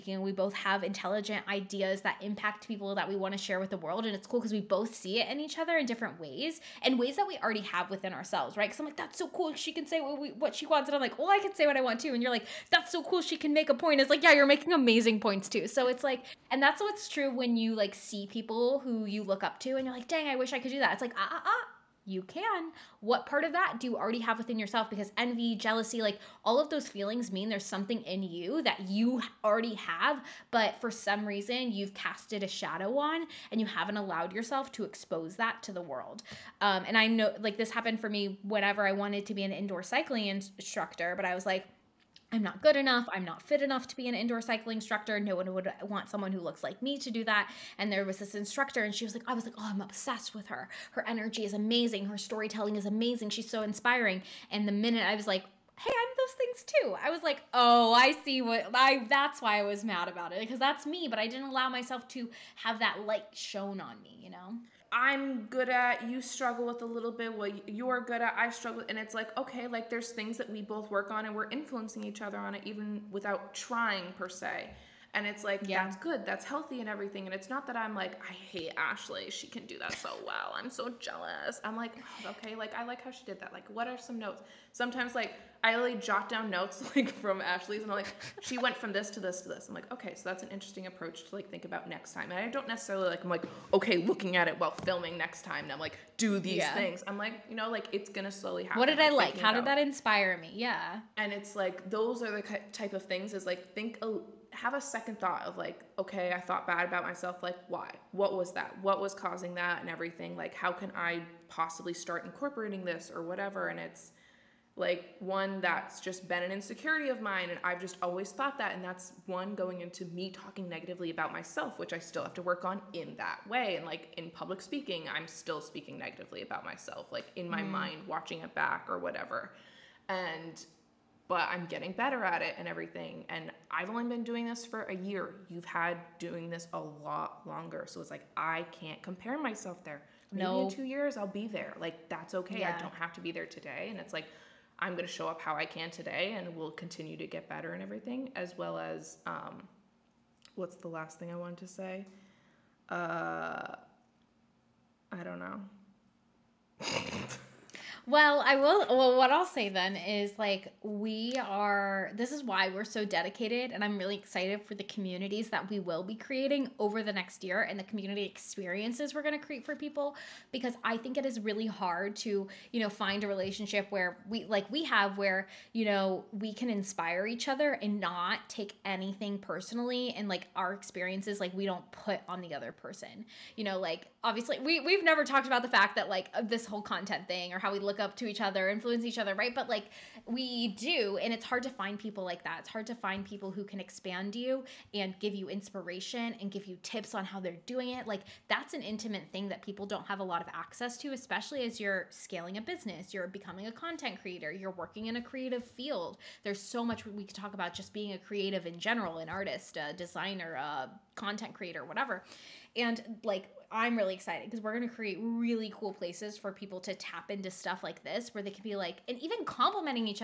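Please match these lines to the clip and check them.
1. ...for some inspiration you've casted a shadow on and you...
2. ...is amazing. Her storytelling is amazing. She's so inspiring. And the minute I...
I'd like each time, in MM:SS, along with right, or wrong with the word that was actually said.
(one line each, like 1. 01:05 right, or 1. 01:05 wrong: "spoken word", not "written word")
1. 00:30 wrong: "reason", not "inspiration"
2. 00:51 right.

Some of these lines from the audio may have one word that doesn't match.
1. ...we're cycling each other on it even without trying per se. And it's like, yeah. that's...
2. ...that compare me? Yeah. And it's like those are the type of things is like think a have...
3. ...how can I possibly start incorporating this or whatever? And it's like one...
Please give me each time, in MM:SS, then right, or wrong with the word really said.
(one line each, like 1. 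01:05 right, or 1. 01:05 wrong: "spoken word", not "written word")
1. 01:11 wrong: "influencing", not "cycling"
2. 01:39 wrong: "inspire", not "compare"
3. 01:50 right.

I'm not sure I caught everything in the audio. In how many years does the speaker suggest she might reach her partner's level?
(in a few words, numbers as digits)
2 years.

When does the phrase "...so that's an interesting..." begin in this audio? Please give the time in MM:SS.
01:30.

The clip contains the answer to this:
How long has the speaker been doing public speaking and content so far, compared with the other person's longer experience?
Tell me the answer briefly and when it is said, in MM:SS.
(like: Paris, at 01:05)
a year, at 02:14.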